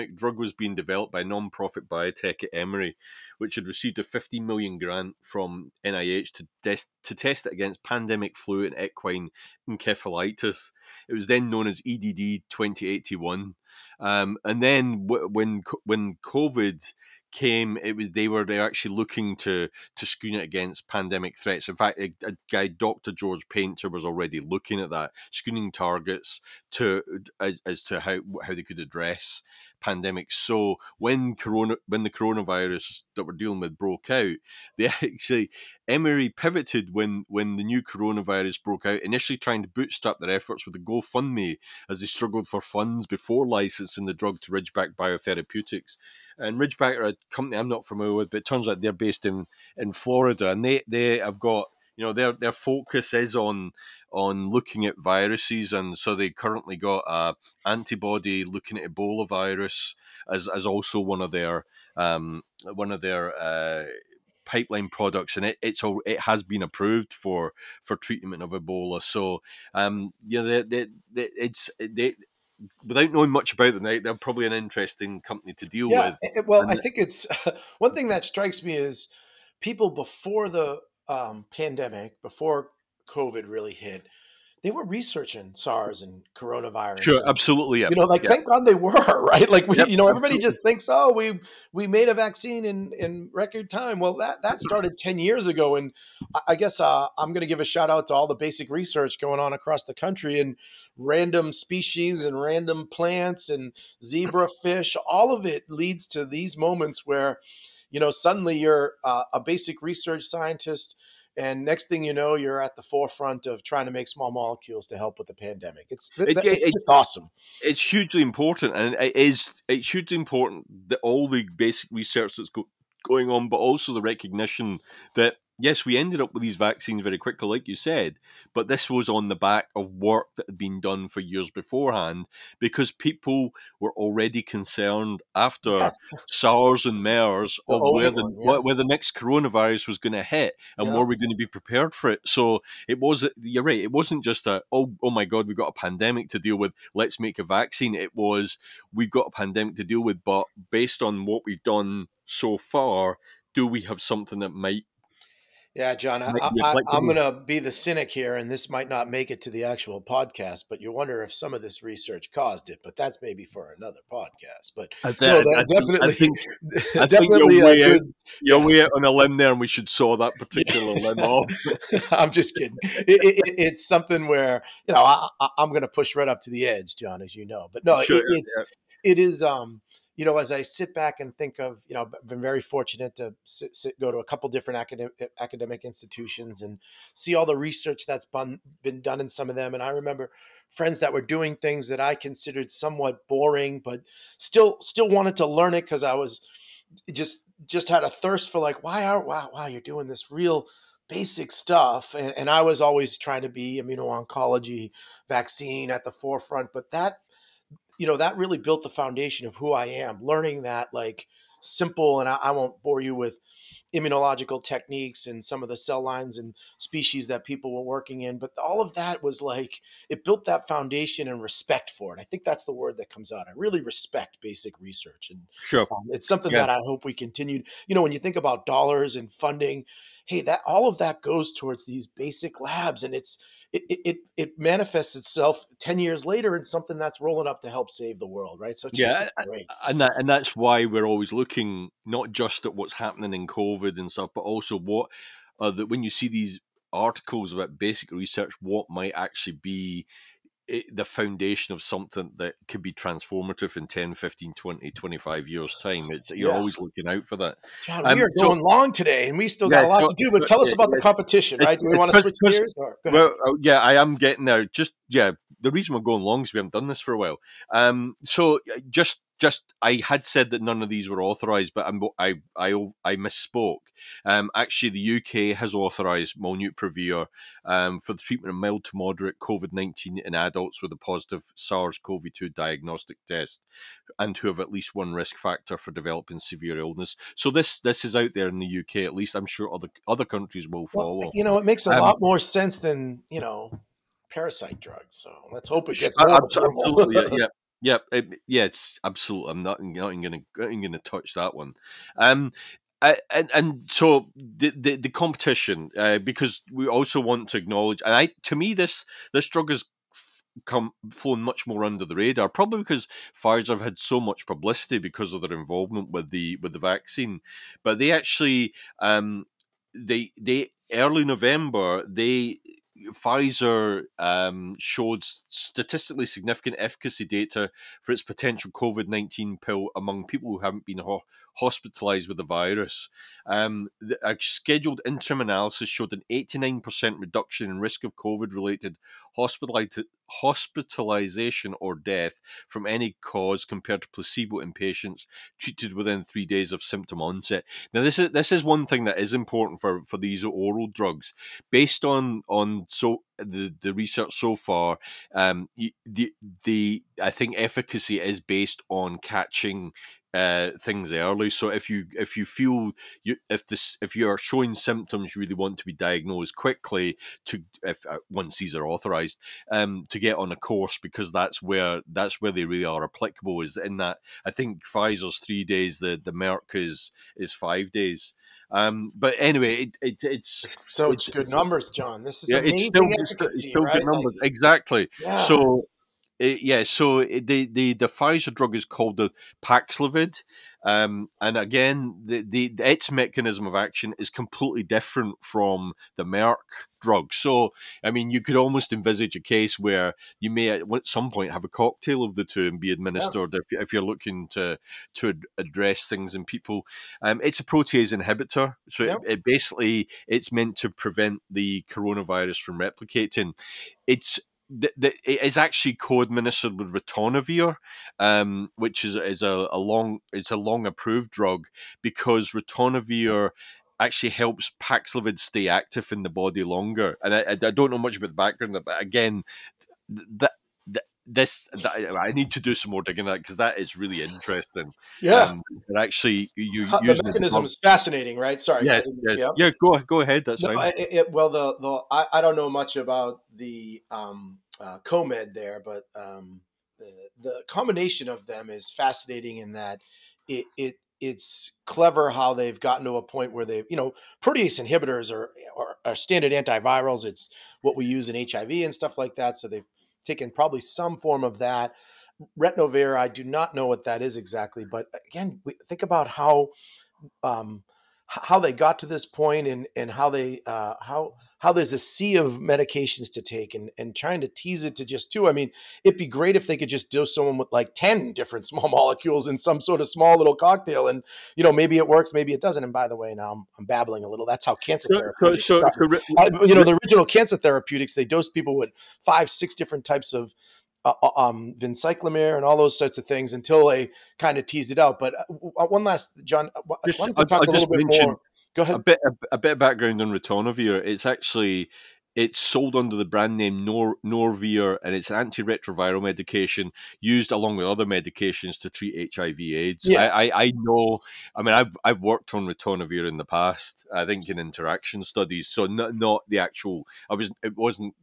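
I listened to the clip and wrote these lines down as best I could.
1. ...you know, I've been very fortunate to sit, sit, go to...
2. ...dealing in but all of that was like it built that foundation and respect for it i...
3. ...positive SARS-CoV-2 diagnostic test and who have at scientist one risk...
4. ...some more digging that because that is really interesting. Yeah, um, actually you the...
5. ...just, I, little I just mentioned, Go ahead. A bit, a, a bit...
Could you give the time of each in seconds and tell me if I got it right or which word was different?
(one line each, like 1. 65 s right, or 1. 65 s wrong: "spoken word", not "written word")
1. 181 s right
2. 217 s wrong: "working", not "dealing"
3. 280 s wrong: "least", not "scientist"
4. 432 s right
5. 497 s right.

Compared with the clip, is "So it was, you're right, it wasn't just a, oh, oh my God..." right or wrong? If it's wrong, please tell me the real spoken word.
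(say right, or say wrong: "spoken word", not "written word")
right.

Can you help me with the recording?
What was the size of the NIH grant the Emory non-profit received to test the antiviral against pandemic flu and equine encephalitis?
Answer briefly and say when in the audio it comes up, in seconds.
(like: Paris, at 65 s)
15 million, at 4 s.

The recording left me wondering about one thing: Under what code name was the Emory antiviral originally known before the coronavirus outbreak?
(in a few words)
EDD 2081.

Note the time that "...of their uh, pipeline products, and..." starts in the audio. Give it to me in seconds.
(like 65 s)
62 s.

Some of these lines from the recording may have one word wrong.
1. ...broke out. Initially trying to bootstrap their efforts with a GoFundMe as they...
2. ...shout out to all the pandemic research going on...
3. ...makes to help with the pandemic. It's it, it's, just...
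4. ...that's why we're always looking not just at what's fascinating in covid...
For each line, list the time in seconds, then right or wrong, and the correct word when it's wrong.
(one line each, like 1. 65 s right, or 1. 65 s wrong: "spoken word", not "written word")
1. 38 s right
2. 97 s wrong: "basic", not "pandemic"
3. 114 s wrong: "molecules", not "makes"
4. 240 s wrong: "happening", not "fascinating".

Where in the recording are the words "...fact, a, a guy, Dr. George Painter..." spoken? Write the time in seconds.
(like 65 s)
21 s.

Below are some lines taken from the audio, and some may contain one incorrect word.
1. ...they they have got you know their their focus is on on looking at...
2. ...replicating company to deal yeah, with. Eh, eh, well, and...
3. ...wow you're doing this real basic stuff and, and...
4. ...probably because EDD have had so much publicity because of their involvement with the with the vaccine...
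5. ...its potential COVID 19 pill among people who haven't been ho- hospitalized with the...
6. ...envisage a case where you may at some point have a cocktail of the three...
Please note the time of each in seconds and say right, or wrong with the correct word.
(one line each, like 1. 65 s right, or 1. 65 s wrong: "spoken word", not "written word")
1. 50 s right
2. 74 s wrong: "interesting", not "replicating"
3. 199 s right
4. 312 s wrong: "Pfizer", not "EDD"
5. 328 s right
6. 398 s wrong: "two", not "three".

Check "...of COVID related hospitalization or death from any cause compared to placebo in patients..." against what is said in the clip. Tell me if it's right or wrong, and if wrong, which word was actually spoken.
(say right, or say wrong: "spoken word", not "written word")
right.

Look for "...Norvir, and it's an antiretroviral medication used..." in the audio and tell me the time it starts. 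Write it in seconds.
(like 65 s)
504 s.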